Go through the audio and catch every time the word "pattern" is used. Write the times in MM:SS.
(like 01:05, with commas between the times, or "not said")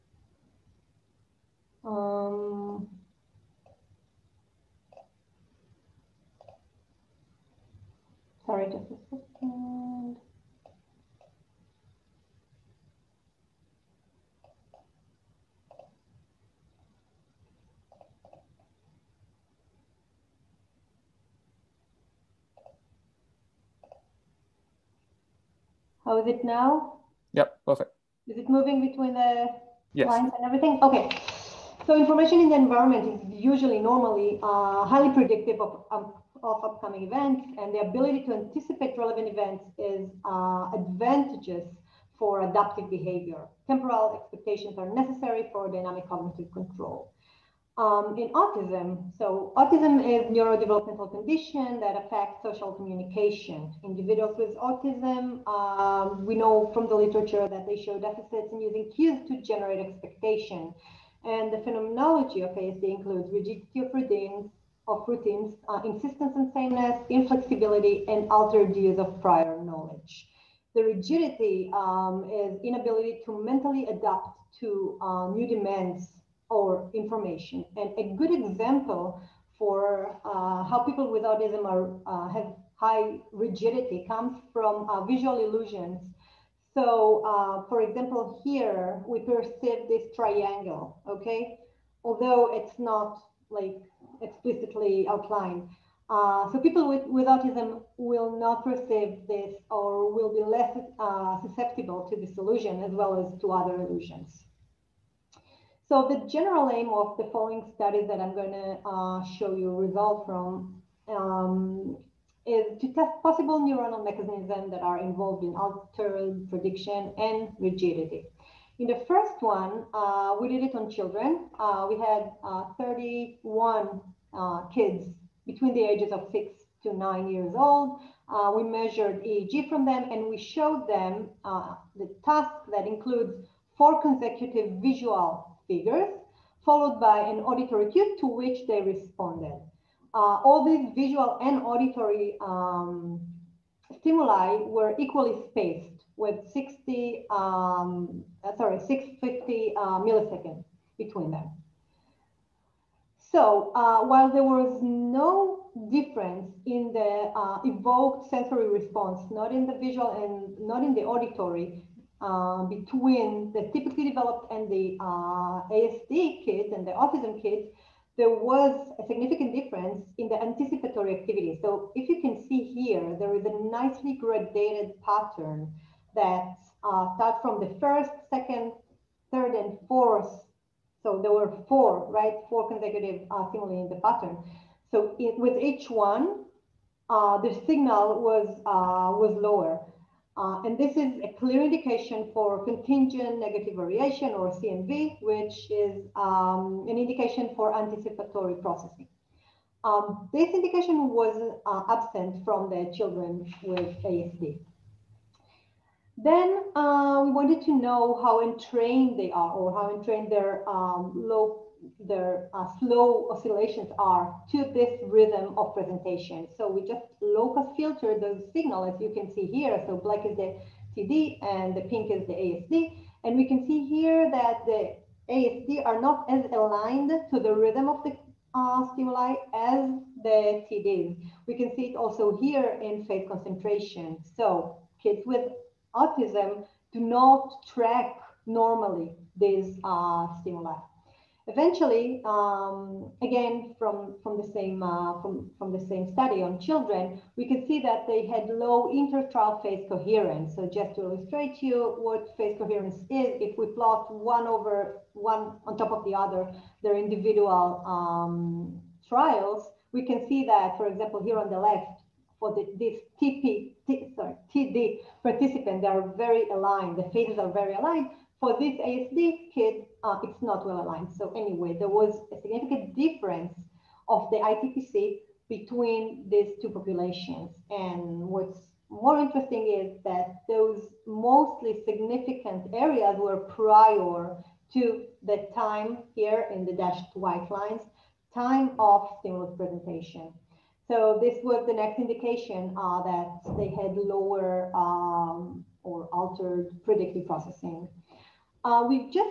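02:55, 03:03.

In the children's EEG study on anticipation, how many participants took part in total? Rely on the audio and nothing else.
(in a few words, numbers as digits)
31.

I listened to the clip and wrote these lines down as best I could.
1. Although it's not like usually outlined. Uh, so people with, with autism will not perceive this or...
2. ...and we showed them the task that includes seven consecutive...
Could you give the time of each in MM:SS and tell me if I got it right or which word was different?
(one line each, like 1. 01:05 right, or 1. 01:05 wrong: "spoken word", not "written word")
1. 01:32 wrong: "explicitly", not "usually"
2. 02:10 wrong: "four", not "seven".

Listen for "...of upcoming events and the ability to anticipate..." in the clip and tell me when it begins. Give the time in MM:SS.
00:35.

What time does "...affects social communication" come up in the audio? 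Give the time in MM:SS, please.
00:52.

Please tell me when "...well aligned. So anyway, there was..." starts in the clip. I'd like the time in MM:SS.
04:30.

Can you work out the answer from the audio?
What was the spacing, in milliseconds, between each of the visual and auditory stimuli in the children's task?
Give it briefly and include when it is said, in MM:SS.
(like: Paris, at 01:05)
650 milliseconds, at 02:28.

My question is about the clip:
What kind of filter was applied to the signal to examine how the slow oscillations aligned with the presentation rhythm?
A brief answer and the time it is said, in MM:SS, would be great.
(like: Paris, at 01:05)
Low-pass, at 03:37.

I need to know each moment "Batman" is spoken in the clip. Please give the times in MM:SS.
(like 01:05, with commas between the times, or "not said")
not said.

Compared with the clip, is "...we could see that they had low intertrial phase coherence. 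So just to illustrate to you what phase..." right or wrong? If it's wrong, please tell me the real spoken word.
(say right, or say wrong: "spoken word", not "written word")
right.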